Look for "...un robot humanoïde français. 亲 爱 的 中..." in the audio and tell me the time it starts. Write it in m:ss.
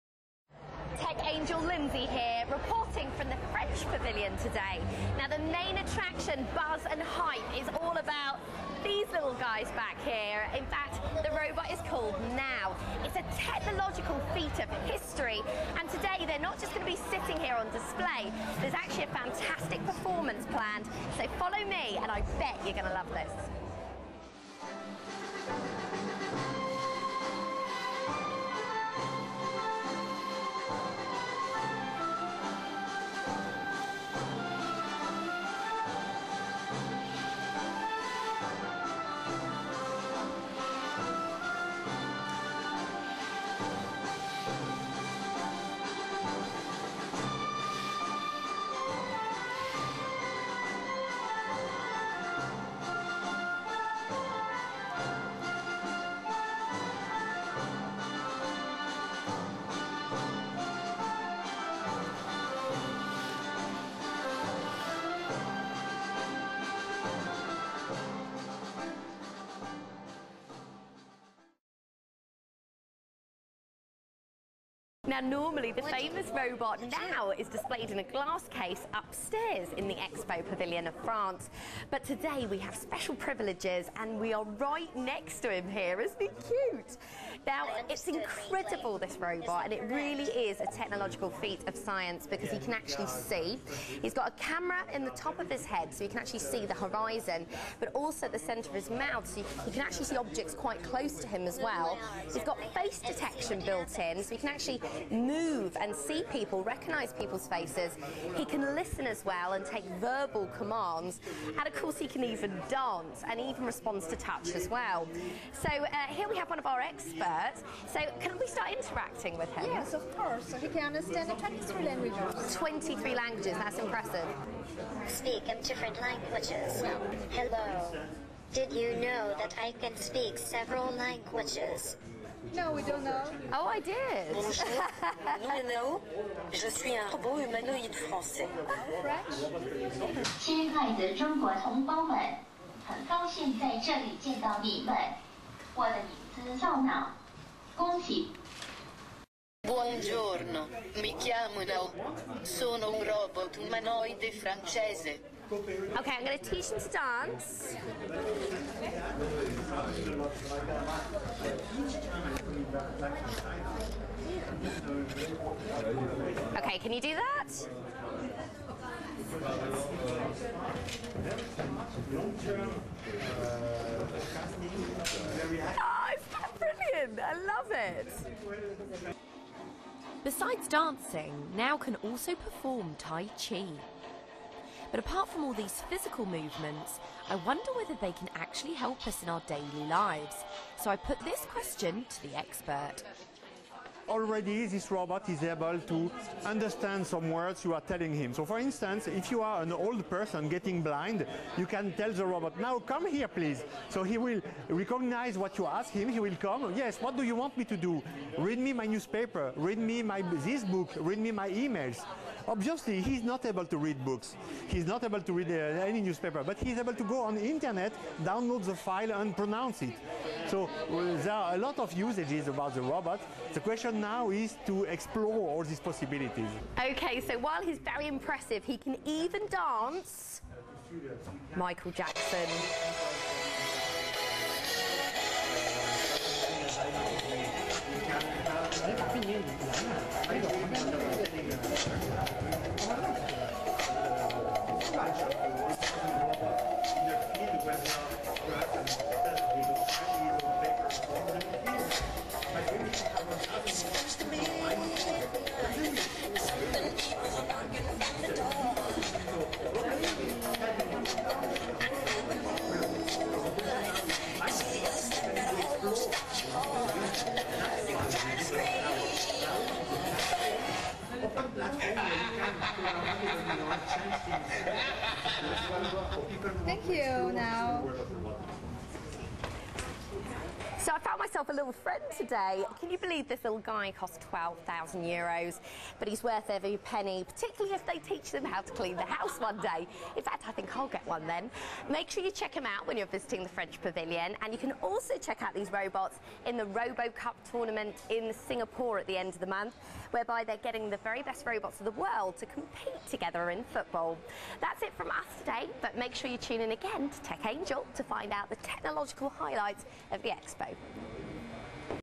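2:16.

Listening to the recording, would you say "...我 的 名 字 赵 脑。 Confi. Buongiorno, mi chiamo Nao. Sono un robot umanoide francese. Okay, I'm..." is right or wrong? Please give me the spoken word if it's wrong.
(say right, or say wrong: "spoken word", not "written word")
right.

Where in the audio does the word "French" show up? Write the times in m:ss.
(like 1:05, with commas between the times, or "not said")
0:03, 4:53.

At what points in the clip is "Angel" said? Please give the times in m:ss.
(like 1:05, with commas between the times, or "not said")
0:01, 5:07.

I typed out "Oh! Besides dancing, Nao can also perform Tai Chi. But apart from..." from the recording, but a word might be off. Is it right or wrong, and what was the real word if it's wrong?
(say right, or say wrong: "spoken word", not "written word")
right.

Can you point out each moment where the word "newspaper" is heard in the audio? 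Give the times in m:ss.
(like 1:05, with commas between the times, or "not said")
3:28, 3:36.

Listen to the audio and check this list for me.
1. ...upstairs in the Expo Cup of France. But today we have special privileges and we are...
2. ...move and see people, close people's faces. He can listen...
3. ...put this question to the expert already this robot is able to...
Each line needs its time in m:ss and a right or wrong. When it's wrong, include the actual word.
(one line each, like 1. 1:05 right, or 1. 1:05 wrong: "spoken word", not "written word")
1. 1:18 wrong: "Pavilion", not "Cup"
2. 1:45 wrong: "recognise", not "close"
3. 3:10 right.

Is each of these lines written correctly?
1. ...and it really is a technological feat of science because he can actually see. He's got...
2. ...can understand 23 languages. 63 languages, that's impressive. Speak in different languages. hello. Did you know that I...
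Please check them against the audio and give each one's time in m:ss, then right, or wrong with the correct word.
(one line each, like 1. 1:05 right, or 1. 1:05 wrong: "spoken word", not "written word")
1. 1:29 right
2. 2:00 wrong: "23", not "63".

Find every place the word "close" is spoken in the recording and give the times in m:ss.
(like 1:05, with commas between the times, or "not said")
1:40.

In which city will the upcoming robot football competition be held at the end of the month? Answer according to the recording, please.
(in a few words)
Singapore.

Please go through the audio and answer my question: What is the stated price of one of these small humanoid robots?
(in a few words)
12,000 euros.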